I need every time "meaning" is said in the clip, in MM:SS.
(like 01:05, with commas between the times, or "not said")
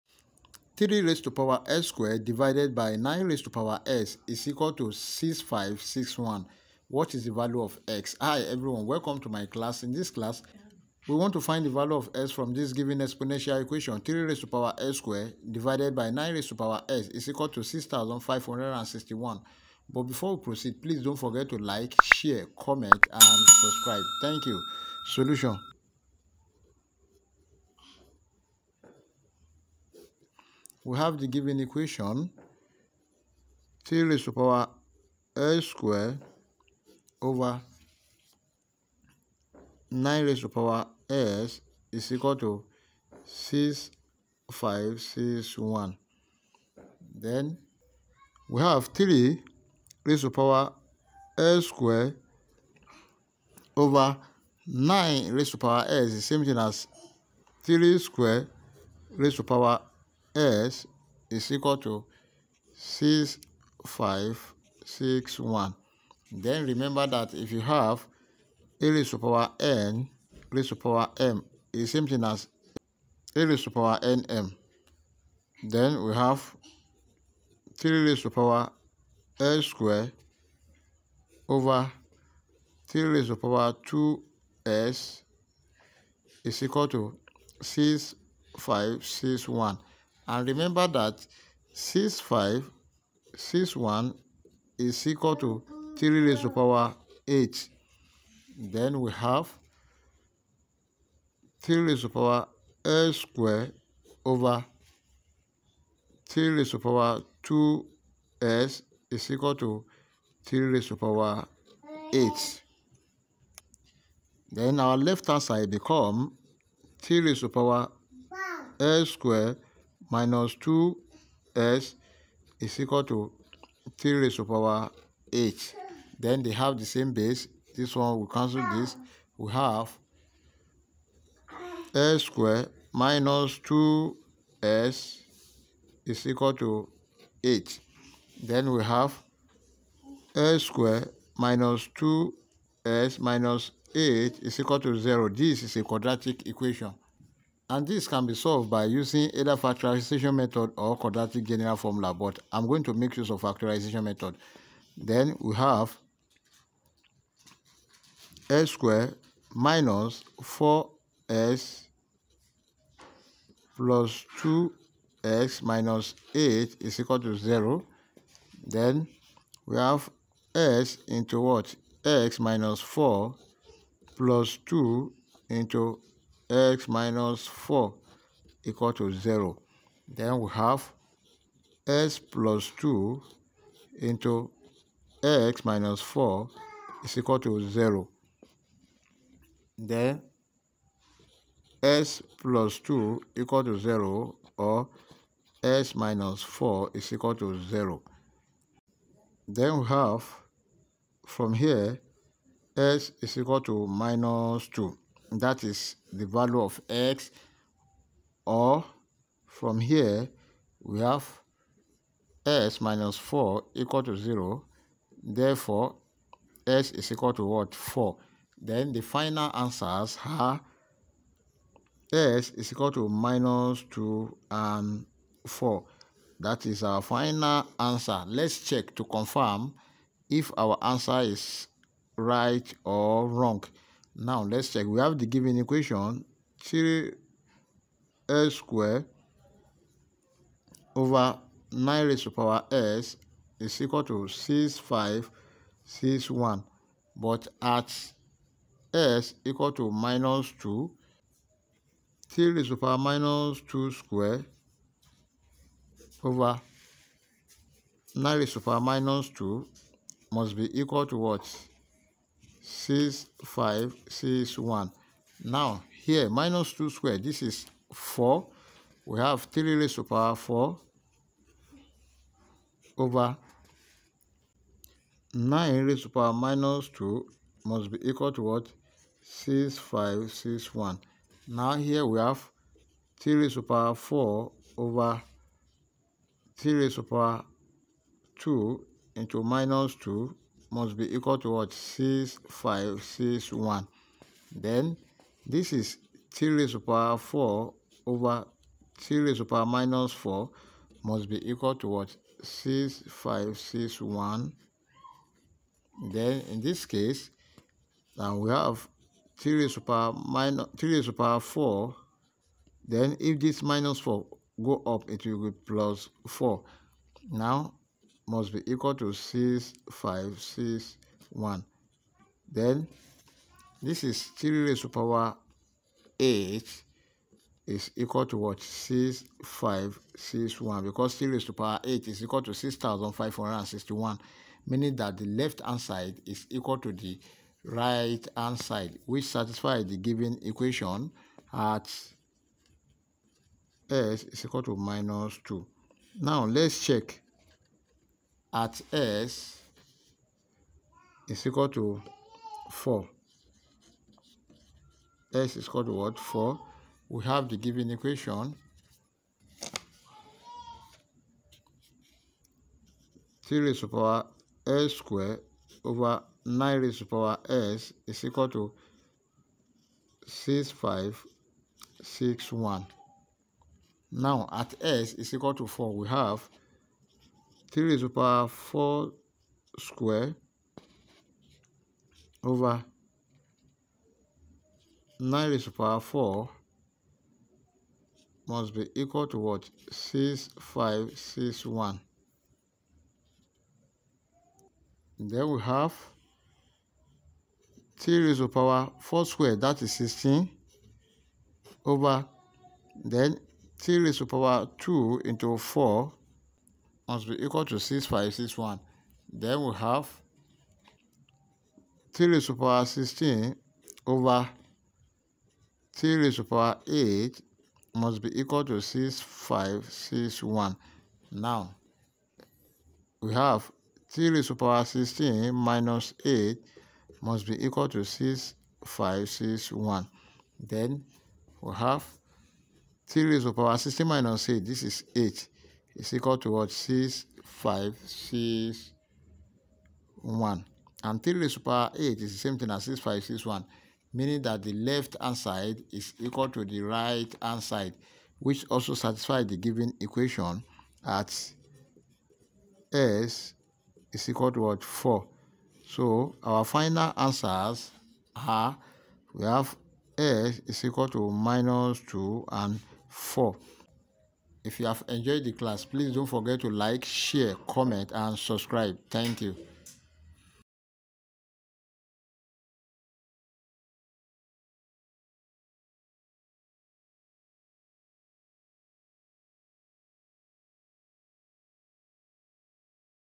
05:34, 07:24.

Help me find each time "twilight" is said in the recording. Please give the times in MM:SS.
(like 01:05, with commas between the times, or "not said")
not said.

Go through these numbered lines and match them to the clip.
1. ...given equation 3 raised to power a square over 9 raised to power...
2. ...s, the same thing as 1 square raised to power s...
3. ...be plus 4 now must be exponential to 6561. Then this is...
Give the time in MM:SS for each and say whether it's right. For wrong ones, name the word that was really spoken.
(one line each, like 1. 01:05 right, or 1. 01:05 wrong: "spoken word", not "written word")
1. 00:31 right
2. 00:55 wrong: "3", not "1"
3. 05:15 wrong: "equal", not "exponential".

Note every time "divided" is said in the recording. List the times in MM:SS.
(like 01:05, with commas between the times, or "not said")
00:02, 00:15.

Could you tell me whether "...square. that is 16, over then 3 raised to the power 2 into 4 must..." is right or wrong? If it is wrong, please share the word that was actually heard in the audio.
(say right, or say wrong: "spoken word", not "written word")
right.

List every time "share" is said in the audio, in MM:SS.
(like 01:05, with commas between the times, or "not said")
00:22, 07:47.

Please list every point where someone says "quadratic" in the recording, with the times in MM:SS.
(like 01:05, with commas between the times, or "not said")
02:25, 02:30.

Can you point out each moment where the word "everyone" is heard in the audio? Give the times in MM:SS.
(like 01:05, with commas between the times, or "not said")
00:08.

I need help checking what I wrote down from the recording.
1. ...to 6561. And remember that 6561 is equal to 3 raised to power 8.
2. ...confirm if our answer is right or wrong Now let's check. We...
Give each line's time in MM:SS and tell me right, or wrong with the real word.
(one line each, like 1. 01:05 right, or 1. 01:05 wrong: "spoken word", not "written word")
1. 01:26 right
2. 03:49 right.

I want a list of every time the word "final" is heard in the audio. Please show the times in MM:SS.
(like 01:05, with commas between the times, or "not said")
03:39, 03:47, 07:36.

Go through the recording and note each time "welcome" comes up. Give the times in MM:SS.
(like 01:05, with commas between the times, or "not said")
00:08.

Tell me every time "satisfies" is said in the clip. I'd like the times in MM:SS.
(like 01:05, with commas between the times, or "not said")
05:39, 07:28.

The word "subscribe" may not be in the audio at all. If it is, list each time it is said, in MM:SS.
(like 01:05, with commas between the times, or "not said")
00:23, 07:48.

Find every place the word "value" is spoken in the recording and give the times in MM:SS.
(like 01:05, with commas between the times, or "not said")
00:07, 00:11, 03:26.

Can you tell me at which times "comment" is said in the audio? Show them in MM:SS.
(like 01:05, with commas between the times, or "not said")
00:22, 07:47.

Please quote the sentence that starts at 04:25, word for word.
Now, here, minus 2 squared, this is 4.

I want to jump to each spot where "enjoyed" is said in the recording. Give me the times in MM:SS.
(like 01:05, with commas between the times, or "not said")
07:45.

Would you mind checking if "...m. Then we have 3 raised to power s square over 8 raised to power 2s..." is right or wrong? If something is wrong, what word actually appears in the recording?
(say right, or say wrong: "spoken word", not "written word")
wrong: "3", not "8".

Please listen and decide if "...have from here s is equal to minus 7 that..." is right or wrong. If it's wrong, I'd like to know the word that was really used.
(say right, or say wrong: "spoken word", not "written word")
wrong: "2", not "7".